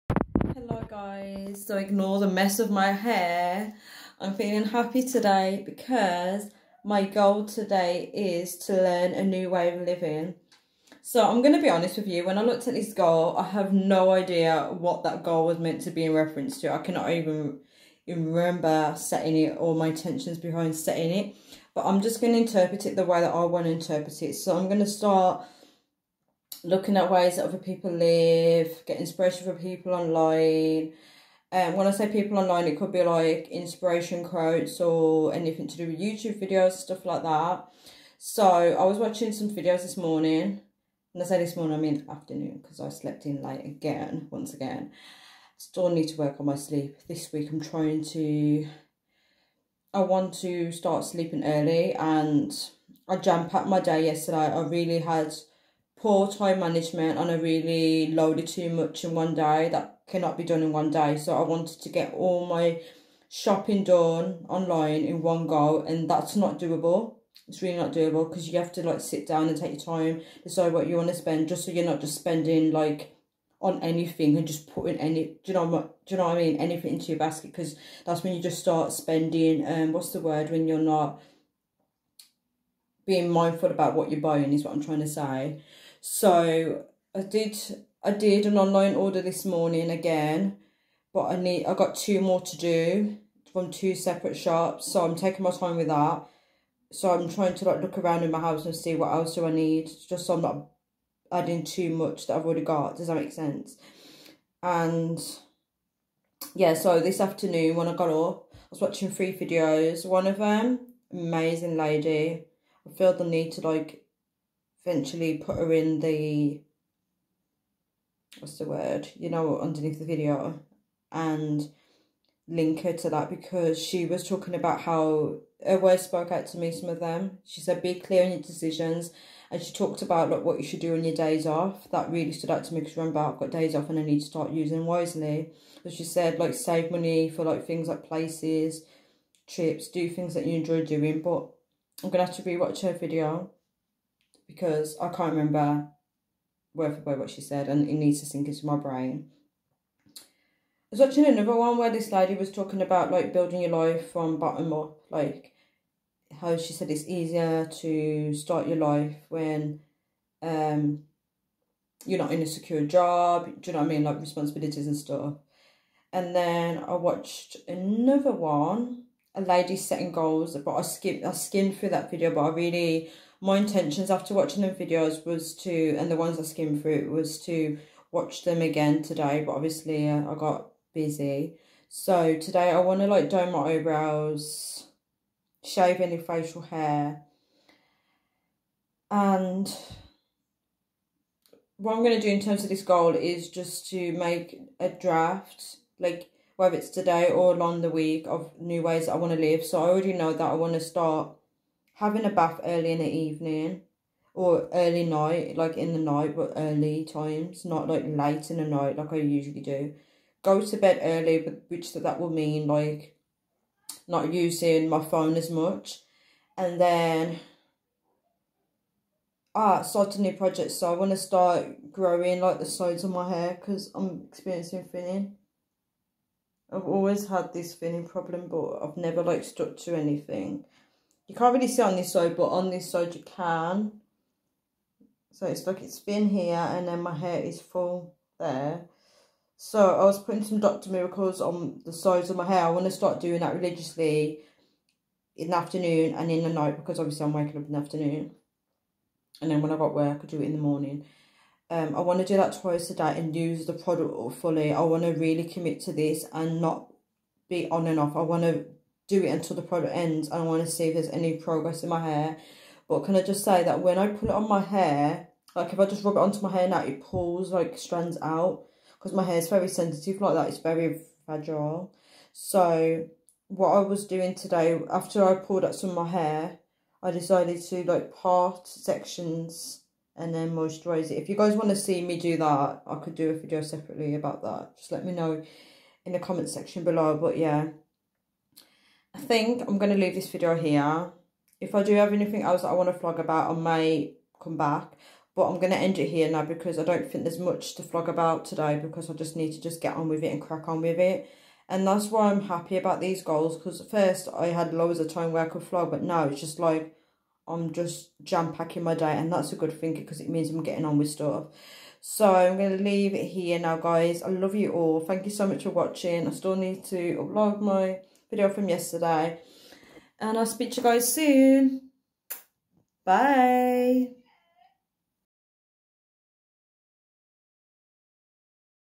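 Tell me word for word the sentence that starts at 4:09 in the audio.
And then when I got work, I do it in the morning.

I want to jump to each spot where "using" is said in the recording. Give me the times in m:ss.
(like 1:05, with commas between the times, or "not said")
2:14, 3:34.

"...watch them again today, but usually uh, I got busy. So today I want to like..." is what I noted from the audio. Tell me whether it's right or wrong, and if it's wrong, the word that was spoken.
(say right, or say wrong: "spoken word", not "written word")
wrong: "obviously", not "usually".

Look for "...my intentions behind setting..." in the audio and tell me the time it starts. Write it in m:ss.
0:19.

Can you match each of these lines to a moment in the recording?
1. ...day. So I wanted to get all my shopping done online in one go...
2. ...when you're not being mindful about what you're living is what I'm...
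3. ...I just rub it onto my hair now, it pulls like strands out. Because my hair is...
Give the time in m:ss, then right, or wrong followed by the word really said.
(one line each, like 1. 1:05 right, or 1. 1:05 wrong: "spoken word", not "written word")
1. 1:00 right
2. 1:20 wrong: "buying", not "living"
3. 4:25 right.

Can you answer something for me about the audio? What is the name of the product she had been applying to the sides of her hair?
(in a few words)
Dr. Miracles.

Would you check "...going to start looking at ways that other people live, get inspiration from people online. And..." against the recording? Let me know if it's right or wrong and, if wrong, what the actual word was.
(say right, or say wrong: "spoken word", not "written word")
right.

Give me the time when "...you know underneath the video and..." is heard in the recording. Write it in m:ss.
1:59.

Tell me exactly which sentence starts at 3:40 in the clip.
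So I want to start growing like the sides of my hair because I'm experiencing thinning.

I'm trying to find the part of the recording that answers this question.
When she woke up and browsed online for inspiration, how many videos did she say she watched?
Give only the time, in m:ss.
1:49.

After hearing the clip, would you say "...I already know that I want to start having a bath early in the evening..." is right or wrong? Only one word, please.
right.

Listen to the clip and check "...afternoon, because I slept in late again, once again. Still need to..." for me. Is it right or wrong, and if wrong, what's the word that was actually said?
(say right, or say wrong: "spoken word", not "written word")
right.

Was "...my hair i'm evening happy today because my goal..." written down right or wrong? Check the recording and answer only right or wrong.
wrong.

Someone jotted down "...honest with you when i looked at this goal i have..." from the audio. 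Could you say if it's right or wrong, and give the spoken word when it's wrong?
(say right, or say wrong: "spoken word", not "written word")
right.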